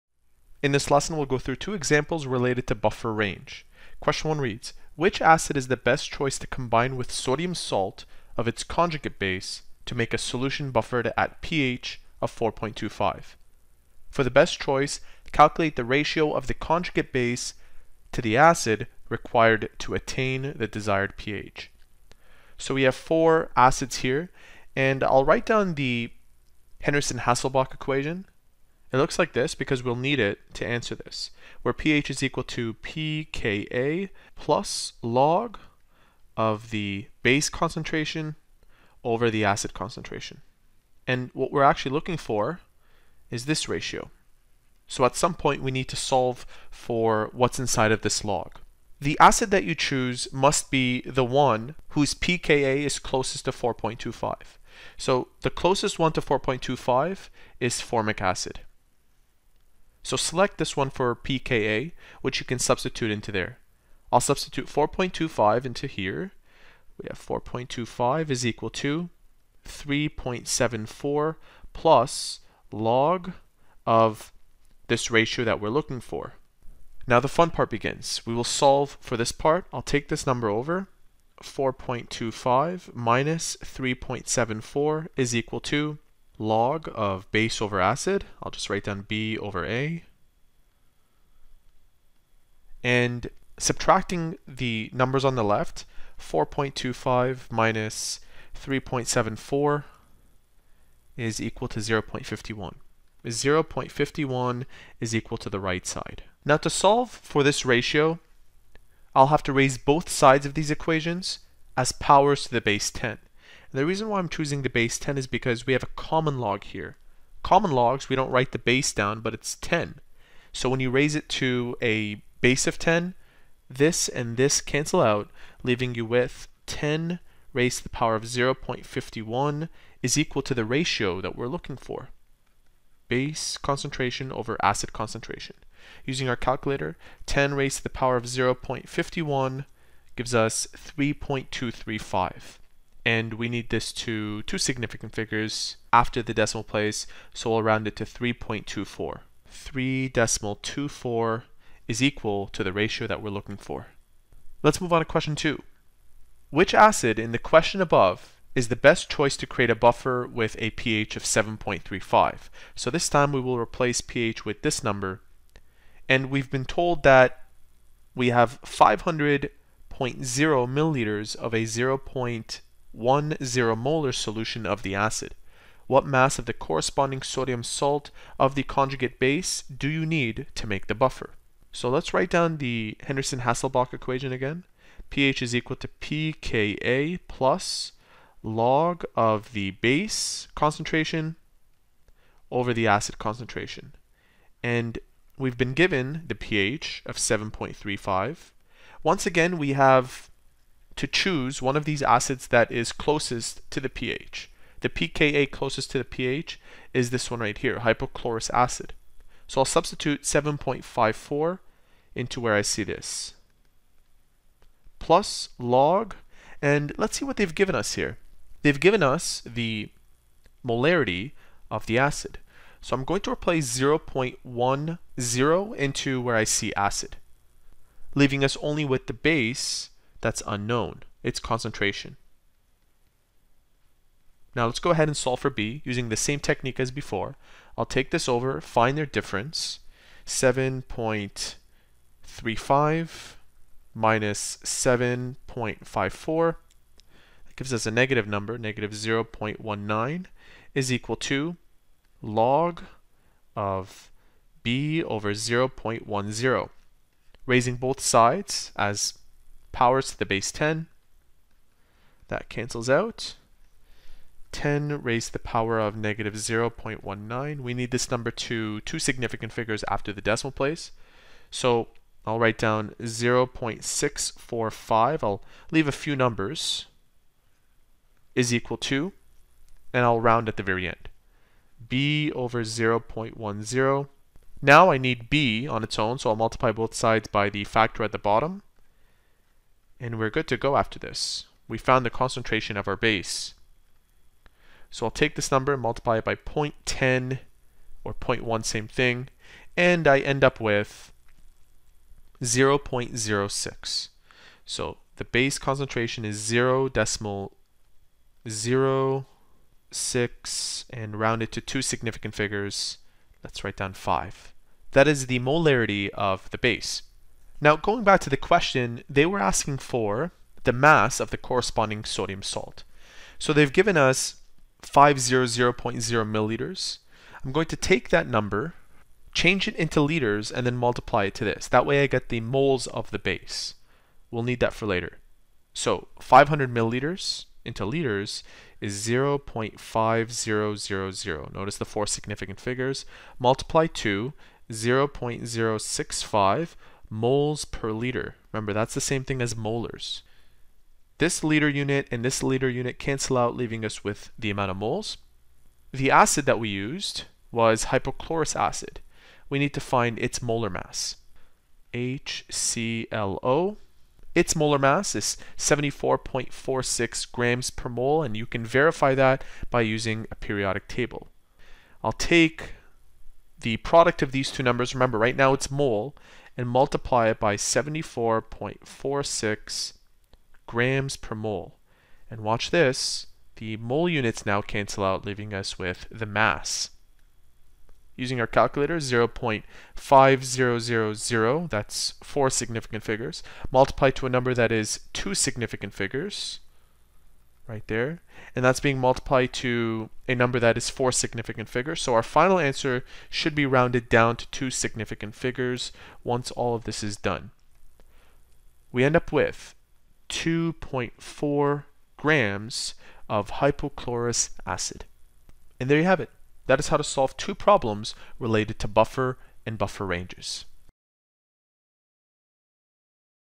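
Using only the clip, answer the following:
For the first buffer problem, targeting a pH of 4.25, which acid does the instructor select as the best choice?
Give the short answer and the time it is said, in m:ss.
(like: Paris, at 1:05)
formic acid, at 0:57.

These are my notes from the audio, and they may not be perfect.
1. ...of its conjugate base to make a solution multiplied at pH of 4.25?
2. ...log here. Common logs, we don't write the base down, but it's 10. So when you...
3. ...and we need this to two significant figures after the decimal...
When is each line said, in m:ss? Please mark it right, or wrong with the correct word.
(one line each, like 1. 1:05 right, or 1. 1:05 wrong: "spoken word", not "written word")
1. 0:08 wrong: "buffered", not "multiplied"
2. 1:56 right
3. 2:23 right.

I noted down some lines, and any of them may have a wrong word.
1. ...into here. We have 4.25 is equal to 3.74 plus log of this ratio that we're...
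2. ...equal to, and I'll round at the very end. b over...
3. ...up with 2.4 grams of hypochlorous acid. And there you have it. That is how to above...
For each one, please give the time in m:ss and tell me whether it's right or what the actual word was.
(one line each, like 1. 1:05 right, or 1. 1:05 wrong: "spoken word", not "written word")
1. 1:05 right
2. 4:38 right
3. 6:49 wrong: "solve", not "above".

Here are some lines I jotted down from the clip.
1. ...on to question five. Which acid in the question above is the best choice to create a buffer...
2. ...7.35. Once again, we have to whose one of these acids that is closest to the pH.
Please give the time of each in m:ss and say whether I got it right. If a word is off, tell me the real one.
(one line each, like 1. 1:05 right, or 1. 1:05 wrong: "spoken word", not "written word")
1. 2:34 wrong: "two", not "five"
2. 3:17 wrong: "choose", not "whose".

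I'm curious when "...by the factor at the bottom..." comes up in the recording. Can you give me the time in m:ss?
4:47.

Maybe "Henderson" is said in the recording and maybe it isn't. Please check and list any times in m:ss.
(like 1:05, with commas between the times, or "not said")
0:26, 3:03.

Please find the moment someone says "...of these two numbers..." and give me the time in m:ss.
6:14.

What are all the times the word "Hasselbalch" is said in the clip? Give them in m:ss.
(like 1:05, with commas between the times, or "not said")
0:26, 3:03.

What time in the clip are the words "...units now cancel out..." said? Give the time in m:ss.
6:24.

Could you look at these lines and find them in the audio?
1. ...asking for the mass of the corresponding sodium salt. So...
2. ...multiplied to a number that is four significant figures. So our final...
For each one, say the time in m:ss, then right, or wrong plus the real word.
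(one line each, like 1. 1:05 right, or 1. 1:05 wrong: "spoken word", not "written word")
1. 5:19 right
2. 6:38 right.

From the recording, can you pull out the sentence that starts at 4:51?
We found the concentration of our base.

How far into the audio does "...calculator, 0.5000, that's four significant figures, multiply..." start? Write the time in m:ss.
6:28.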